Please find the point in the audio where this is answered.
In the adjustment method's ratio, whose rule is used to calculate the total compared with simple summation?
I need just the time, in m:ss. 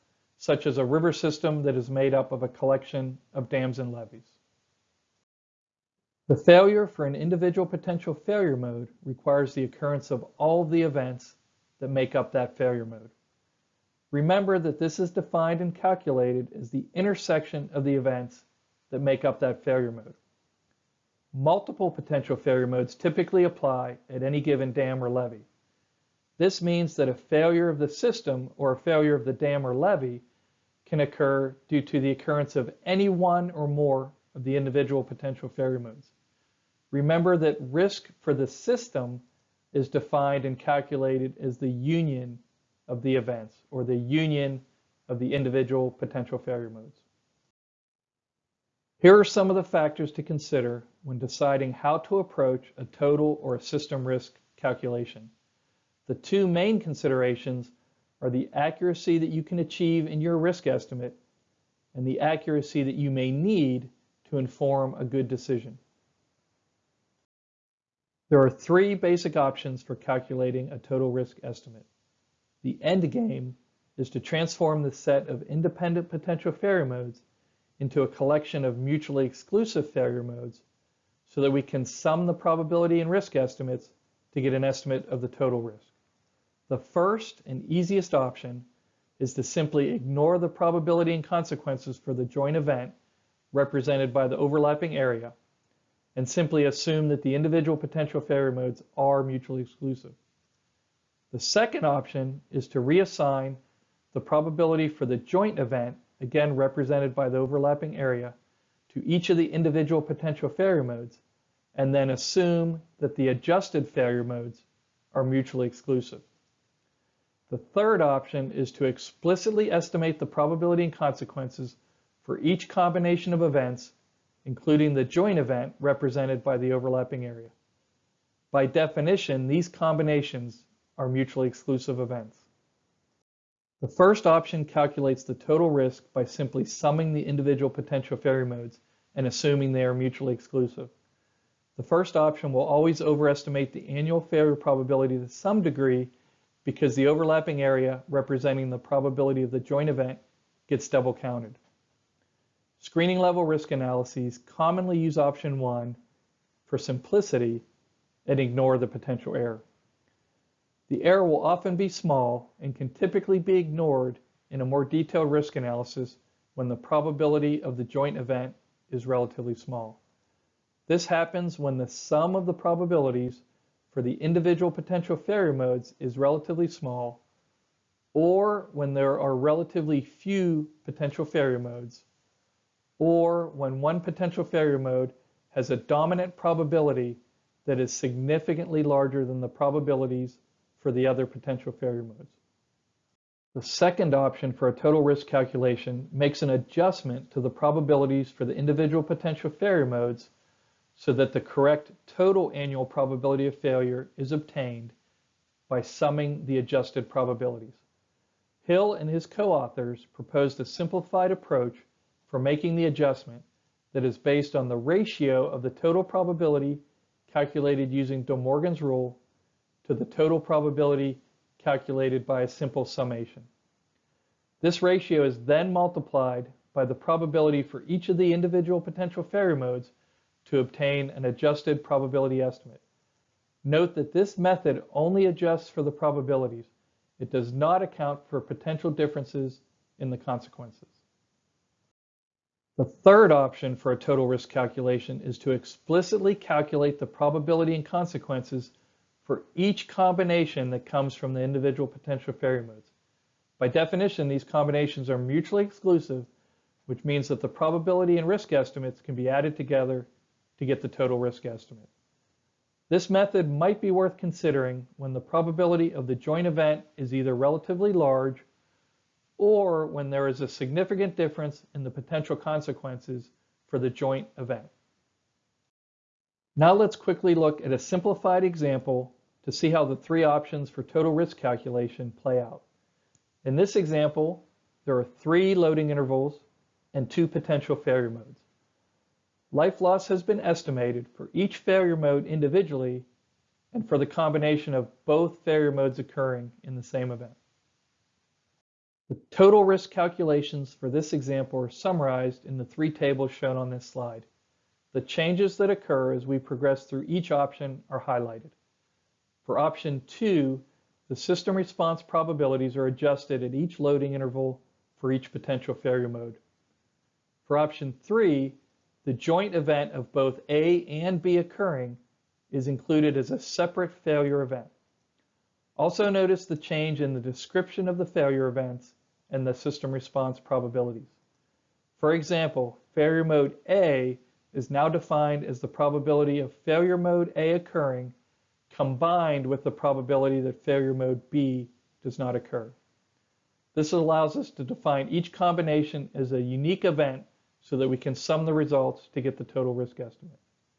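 3:38.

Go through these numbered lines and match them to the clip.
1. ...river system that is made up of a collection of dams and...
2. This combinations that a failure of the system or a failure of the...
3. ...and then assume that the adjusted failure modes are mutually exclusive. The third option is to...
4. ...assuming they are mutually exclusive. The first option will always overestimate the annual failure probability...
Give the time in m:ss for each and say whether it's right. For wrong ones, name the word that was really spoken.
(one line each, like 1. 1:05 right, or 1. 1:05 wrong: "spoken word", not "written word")
1. 0:00 right
2. 0:26 wrong: "means", not "combinations"
3. 1:51 right
4. 2:19 right.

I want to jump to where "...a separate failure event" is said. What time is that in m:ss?
5:23.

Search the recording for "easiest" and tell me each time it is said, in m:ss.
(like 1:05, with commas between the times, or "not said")
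1:27.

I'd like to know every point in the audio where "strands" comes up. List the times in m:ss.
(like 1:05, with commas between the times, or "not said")
not said.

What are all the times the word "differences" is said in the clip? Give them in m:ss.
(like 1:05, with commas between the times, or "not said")
3:58, 4:31.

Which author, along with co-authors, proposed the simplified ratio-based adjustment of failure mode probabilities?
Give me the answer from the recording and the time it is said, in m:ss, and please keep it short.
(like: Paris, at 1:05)
Hill, at 3:28.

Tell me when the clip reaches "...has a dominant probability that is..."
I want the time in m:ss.
3:05.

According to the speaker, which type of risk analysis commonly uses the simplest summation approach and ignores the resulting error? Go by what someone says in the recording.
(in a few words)
Screening level risk analyses.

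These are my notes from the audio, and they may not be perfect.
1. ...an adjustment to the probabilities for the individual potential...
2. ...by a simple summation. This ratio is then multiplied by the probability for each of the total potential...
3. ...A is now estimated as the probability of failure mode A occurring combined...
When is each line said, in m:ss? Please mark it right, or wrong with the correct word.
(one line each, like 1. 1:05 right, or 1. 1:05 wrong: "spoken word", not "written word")
1. 3:16 right
2. 3:42 wrong: "individual", not "total"
3. 5:33 wrong: "defined", not "estimated".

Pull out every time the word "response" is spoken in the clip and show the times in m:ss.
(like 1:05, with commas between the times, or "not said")
5:11, 5:29.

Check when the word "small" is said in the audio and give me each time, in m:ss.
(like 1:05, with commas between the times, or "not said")
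2:41, 2:49, 2:56.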